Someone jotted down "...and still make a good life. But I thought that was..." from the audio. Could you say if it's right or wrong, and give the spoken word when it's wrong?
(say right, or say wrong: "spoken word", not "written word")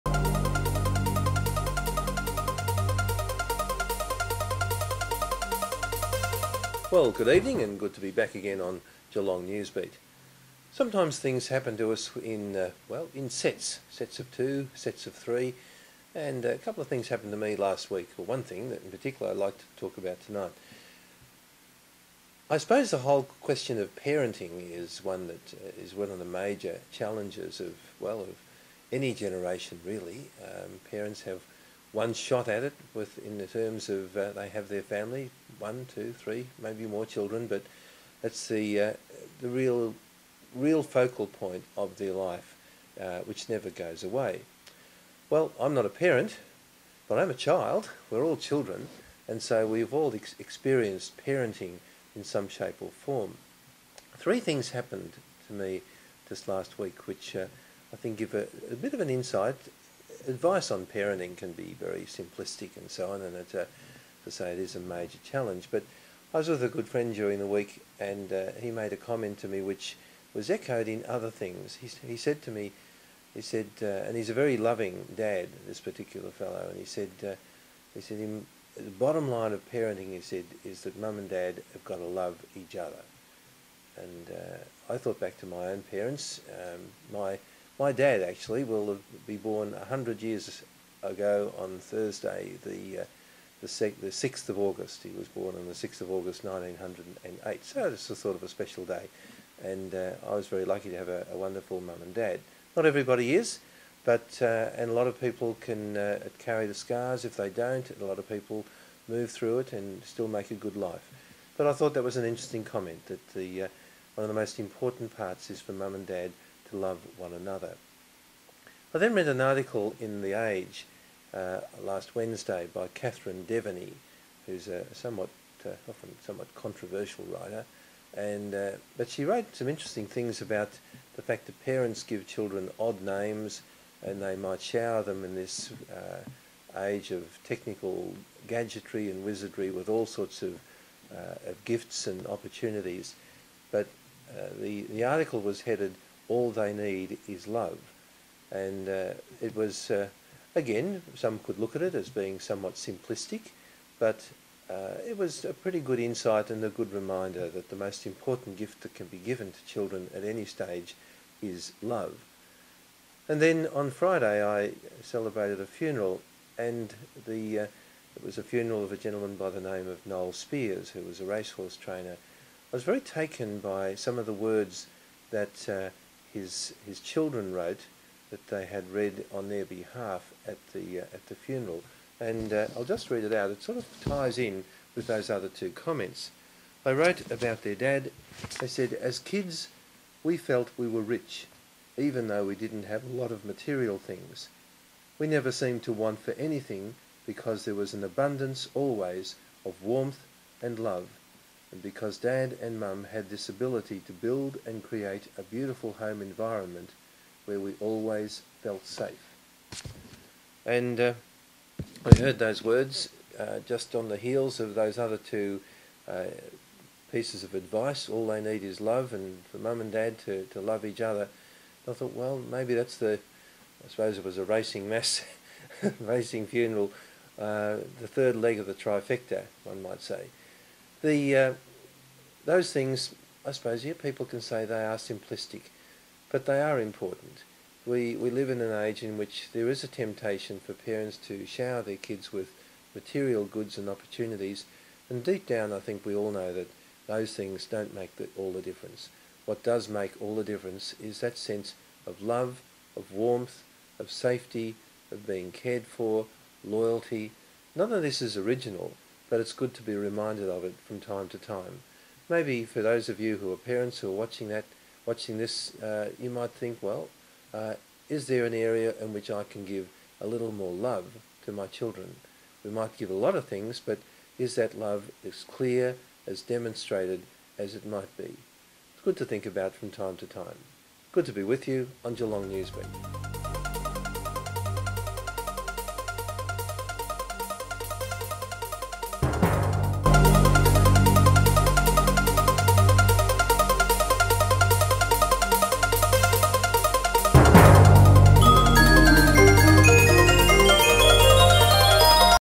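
right.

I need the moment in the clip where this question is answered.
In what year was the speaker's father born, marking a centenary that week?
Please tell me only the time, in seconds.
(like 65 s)
96 s.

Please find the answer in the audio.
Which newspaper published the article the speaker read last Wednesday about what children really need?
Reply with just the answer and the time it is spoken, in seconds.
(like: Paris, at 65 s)
The Age, at 120 s.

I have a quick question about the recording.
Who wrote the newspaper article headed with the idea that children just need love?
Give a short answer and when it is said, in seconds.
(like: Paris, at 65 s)
Catherine Deveny, at 122 s.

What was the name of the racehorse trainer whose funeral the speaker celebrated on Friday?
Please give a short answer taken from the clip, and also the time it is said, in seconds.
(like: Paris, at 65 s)
Noel Spears, at 170 s.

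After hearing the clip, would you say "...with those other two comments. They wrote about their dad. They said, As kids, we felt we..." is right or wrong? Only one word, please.
right.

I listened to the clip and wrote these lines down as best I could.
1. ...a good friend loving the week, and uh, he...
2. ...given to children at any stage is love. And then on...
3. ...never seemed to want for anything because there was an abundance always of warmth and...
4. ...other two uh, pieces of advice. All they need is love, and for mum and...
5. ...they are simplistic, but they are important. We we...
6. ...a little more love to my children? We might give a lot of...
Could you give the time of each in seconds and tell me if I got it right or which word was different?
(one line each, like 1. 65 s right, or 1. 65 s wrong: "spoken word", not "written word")
1. 66 s wrong: "during", not "loving"
2. 159 s right
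3. 195 s right
4. 214 s right
5. 234 s right
6. 270 s right.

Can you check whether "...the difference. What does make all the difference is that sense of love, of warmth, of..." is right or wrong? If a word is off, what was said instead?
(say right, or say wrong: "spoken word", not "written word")
right.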